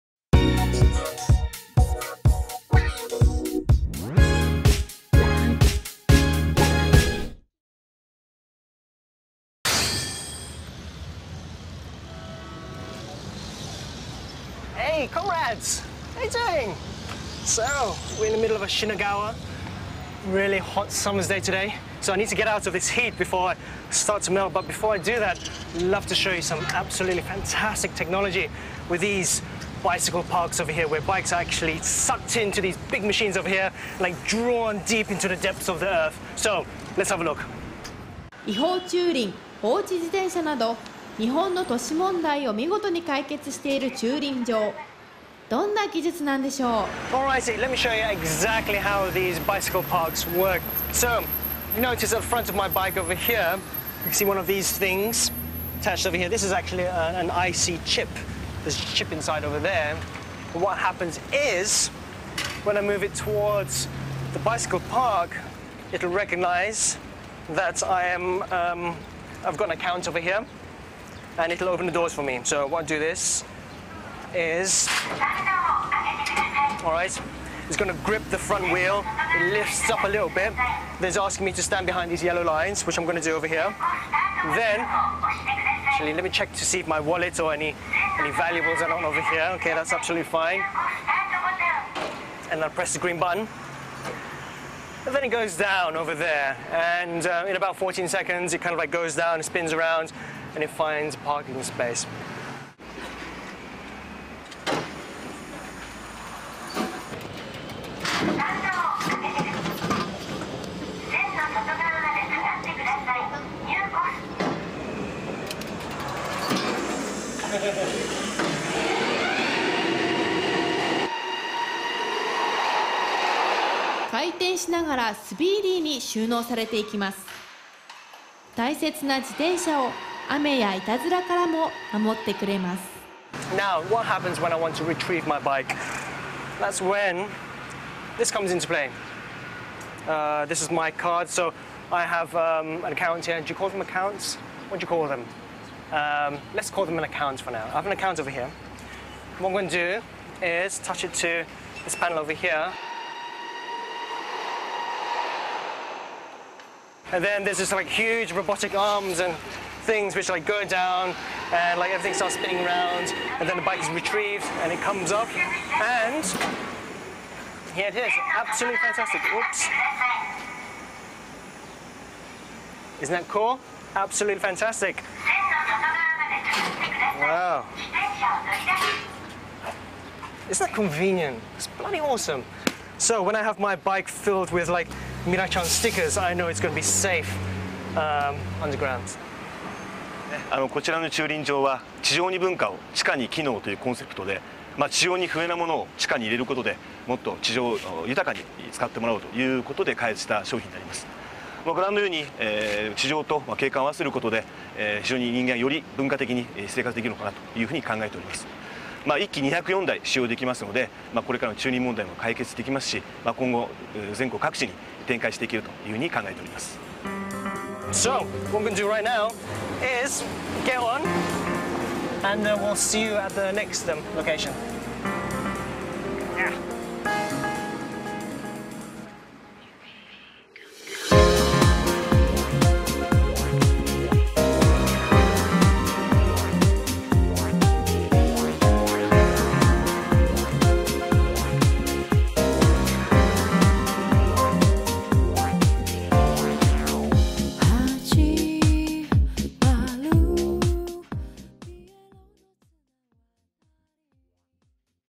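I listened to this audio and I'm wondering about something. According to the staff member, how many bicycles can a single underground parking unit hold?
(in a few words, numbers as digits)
204.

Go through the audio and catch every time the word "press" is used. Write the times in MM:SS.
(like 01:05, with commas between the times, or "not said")
01:32.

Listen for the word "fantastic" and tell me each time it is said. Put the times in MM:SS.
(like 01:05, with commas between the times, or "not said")
00:27, 02:48, 02:54.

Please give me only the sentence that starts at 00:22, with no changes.
So I need to get out of this heat before I start to melt.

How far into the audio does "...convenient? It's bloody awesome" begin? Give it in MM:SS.
03:00.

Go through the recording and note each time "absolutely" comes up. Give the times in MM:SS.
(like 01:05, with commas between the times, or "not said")
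00:26, 01:29, 02:48, 02:53.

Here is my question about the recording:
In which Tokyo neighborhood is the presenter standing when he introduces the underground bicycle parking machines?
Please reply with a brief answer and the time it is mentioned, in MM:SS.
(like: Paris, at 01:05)
Shinagawa, at 00:18.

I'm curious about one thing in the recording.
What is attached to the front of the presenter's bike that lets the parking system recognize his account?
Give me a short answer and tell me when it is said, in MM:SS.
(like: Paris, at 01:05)
IC chip, at 00:57.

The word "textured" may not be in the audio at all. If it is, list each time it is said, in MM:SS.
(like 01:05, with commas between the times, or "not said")
not said.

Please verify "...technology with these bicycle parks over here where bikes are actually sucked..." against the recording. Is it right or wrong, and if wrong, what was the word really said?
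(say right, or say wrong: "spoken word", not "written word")
right.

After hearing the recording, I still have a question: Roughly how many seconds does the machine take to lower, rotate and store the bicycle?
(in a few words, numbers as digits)
14 seconds.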